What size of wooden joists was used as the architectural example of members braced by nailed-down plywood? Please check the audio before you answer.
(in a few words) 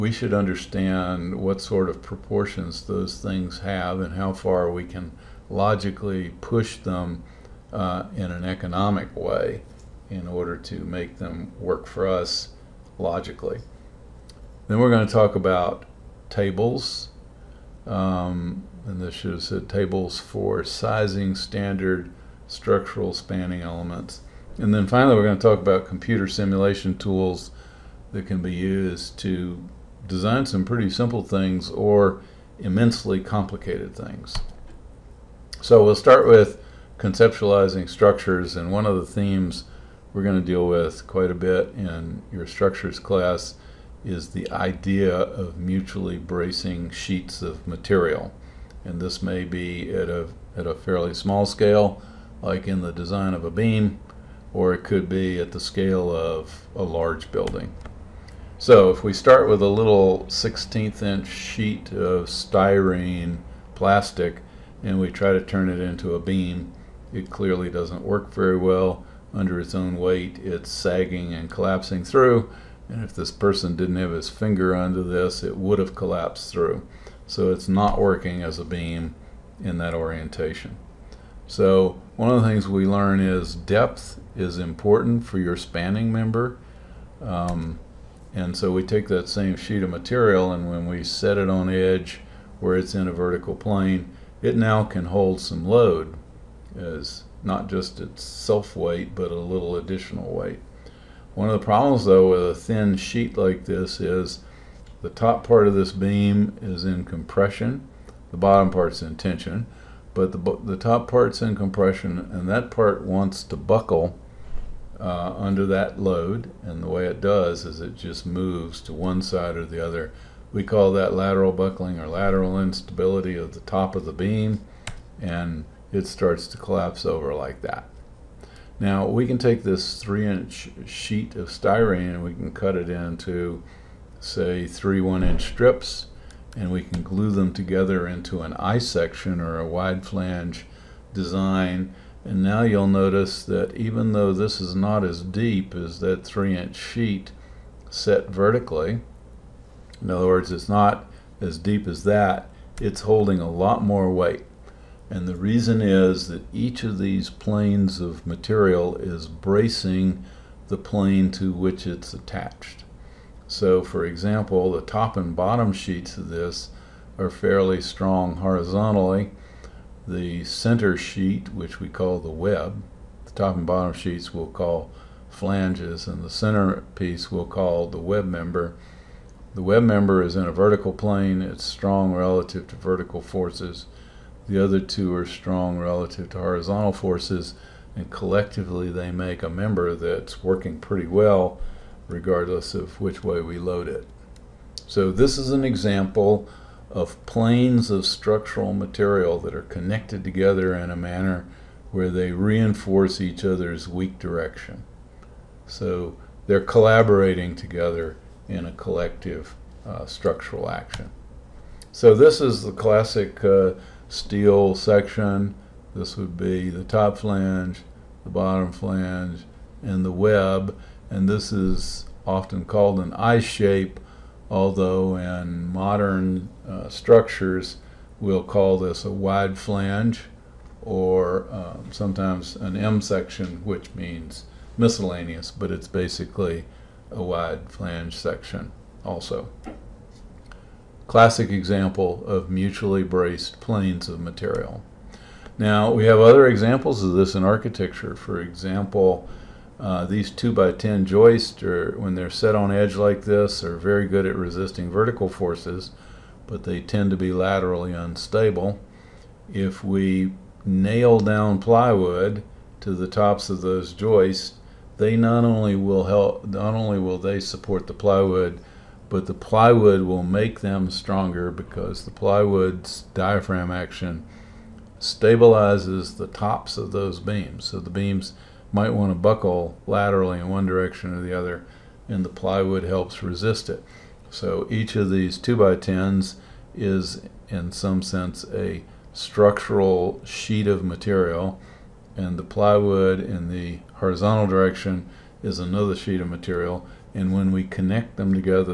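2 by 10.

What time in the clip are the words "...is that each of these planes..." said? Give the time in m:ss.
2:35.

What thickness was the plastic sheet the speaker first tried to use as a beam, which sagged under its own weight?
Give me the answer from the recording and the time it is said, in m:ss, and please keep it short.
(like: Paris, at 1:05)
1/16 inch, at 1:00.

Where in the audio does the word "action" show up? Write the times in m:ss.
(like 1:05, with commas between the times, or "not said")
3:30, 4:33.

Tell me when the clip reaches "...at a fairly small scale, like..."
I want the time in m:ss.
0:50.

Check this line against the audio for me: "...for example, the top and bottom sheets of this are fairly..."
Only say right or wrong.
right.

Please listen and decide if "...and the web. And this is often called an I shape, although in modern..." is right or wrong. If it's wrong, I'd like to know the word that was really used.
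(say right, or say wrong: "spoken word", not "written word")
right.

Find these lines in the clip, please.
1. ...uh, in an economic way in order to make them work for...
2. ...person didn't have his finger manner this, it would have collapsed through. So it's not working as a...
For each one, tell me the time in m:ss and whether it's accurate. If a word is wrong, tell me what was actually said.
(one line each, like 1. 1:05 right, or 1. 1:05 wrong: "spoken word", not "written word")
1. 0:07 right
2. 1:13 wrong: "under", not "manner".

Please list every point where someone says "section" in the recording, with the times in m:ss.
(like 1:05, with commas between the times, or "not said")
2:18, 3:34, 3:53, 3:58.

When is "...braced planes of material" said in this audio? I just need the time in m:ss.
4:03.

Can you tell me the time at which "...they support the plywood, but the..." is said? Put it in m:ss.
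4:27.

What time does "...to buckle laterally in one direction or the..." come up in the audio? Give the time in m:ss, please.
4:39.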